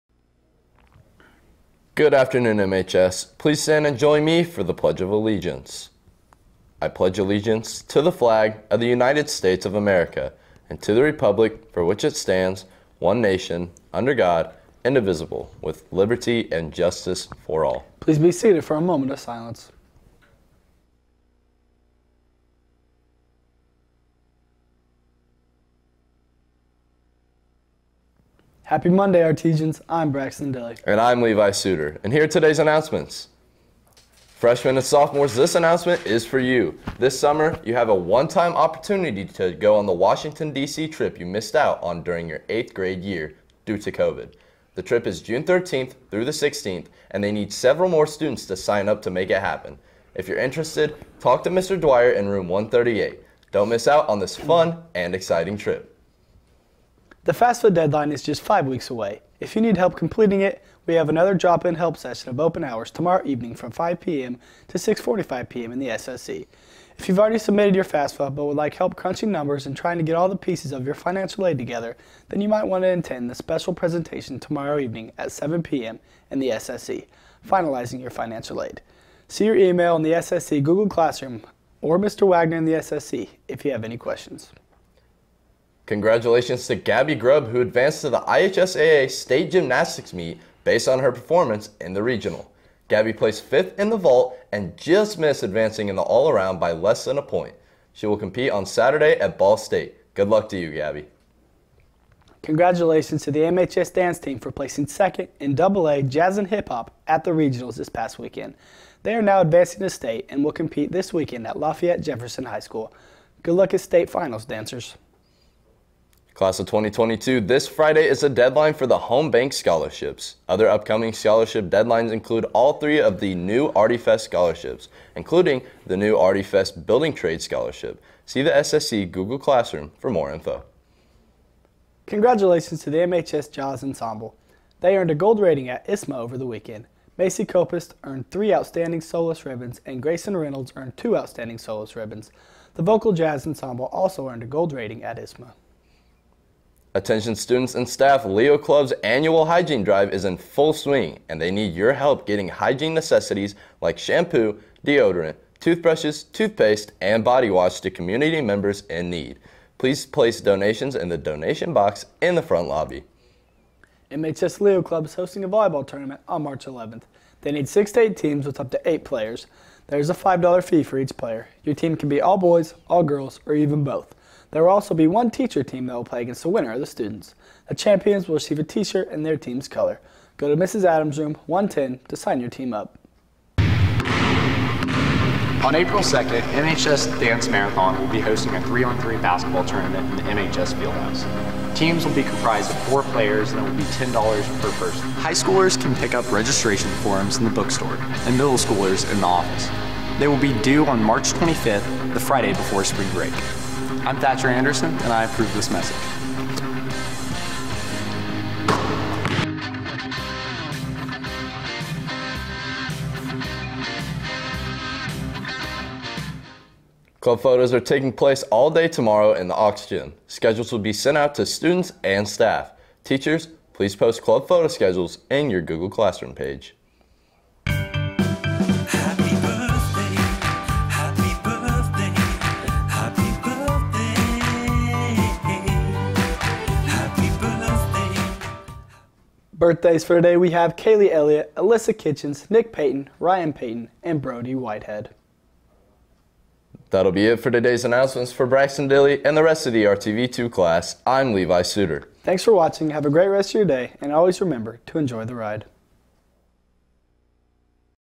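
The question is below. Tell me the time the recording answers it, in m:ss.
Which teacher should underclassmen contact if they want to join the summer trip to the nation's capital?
0:51.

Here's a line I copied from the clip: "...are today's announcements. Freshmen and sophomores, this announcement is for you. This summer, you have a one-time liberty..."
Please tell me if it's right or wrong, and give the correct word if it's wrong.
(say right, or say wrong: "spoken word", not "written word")
wrong: "opportunity", not "liberty".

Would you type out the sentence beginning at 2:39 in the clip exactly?
Please place donations in the donation box in the front lobby.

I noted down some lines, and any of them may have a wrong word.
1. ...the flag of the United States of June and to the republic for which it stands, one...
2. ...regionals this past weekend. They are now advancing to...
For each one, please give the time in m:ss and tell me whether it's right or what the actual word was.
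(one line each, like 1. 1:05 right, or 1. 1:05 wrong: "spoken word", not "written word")
1. 0:08 wrong: "America", not "June"
2. 1:47 right.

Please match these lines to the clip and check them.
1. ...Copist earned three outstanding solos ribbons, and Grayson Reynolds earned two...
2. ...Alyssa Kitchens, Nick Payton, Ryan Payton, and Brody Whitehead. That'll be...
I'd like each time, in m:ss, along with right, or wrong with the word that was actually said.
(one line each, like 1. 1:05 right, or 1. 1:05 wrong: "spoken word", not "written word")
1. 2:17 right
2. 4:01 right.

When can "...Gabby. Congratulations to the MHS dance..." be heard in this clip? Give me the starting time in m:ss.
1:40.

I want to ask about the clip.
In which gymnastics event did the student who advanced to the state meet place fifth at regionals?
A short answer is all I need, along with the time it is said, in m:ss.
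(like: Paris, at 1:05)
vault, at 1:33.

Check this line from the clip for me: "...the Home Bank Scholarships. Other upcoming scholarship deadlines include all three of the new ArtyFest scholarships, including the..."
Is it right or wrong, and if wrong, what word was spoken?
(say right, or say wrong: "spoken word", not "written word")
right.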